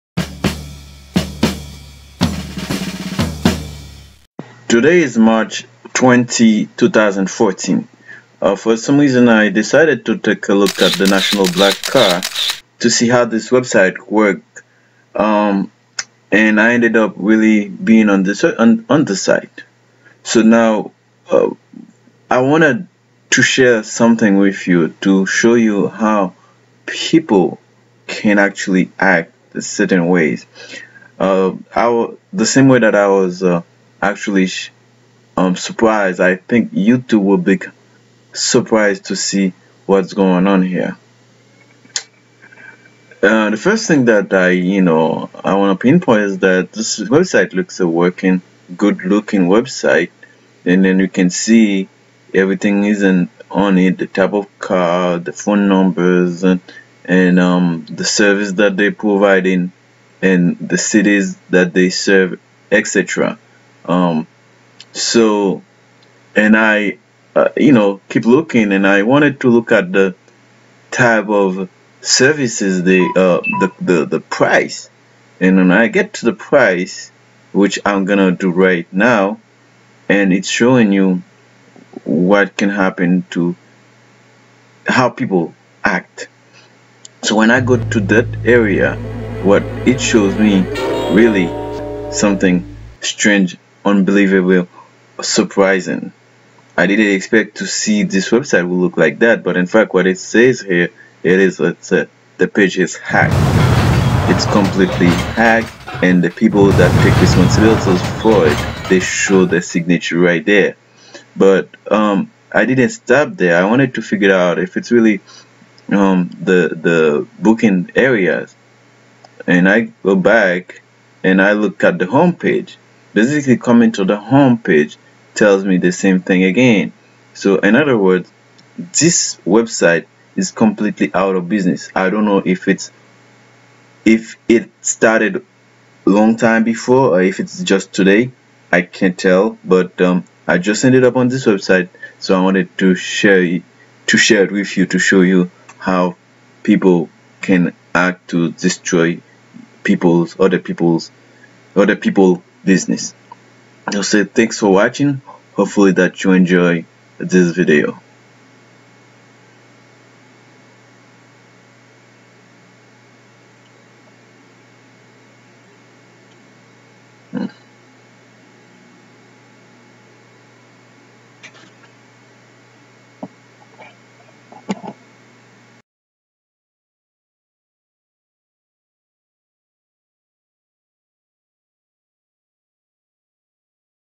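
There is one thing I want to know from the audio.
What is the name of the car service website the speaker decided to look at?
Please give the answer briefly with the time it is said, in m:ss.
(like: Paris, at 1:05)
National Black Car, at 0:11.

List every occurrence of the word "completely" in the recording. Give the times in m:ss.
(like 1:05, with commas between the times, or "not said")
1:44, 2:10.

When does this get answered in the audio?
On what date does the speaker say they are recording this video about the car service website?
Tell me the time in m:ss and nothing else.
0:05.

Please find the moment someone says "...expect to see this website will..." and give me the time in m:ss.
1:37.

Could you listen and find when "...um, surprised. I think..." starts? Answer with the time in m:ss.
0:35.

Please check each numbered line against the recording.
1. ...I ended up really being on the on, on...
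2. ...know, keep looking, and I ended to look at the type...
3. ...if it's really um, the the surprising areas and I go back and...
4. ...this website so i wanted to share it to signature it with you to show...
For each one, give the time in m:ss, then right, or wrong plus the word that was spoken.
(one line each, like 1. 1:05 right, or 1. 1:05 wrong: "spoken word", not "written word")
1. 0:16 right
2. 1:07 wrong: "wanted", not "ended"
3. 1:54 wrong: "booking", not "surprising"
4. 2:21 wrong: "share", not "signature".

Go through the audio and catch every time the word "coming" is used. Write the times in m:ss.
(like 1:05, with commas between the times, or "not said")
2:03.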